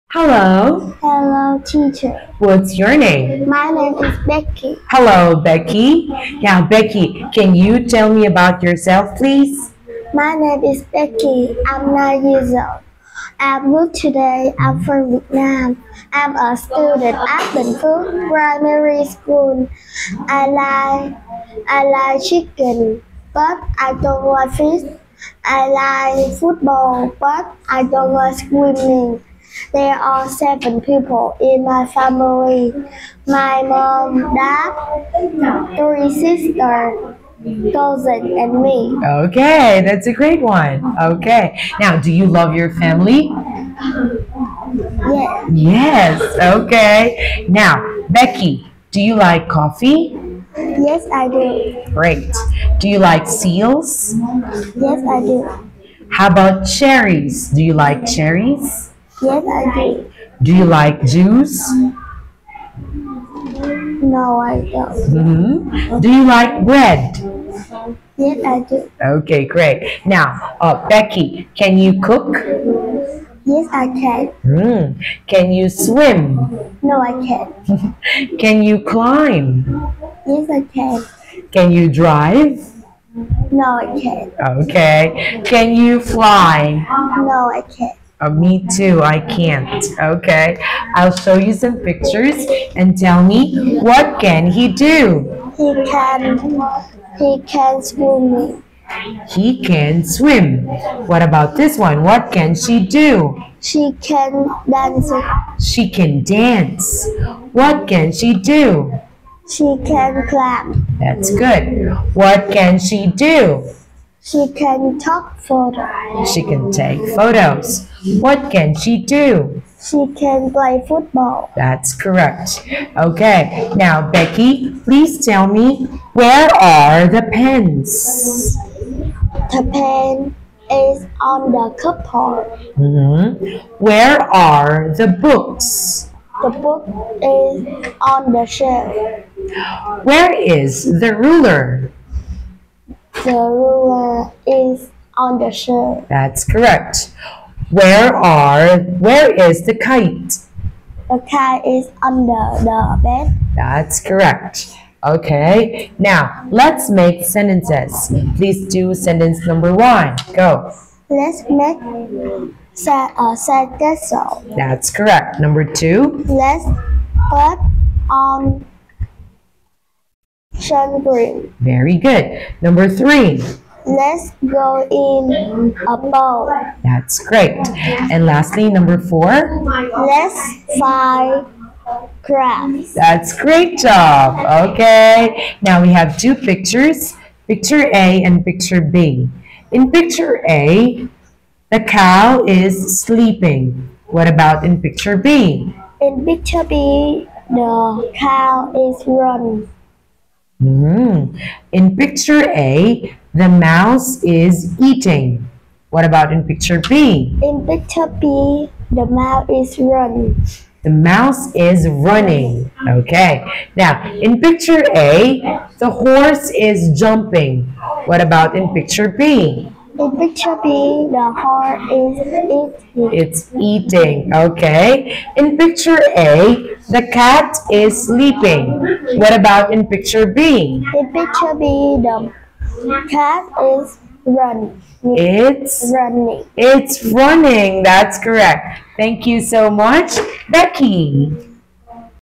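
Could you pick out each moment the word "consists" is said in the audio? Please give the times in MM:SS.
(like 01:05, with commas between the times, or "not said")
not said.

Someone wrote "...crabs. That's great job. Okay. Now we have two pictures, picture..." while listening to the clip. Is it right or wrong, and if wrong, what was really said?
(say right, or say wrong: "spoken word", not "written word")
right.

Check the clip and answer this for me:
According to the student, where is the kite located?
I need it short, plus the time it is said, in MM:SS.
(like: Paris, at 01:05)
under the bed, at 02:32.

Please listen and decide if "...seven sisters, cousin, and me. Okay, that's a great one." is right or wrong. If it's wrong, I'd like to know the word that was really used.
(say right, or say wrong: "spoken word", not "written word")
wrong: "three", not "seven".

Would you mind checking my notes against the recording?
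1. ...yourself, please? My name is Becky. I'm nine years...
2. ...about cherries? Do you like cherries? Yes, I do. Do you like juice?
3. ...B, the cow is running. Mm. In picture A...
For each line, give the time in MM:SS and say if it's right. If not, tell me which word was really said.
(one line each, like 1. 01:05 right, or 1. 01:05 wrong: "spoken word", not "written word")
1. 00:08 right
2. 00:56 right
3. 03:16 right.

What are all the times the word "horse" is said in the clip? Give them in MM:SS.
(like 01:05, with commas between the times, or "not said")
03:35, 03:41.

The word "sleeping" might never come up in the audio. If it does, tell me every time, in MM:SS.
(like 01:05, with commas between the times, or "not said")
03:13, 03:48.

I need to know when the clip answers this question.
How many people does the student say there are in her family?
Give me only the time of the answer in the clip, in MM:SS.
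00:30.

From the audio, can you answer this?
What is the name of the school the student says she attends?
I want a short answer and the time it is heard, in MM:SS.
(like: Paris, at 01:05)
Bình Phước Primary School, at 00:17.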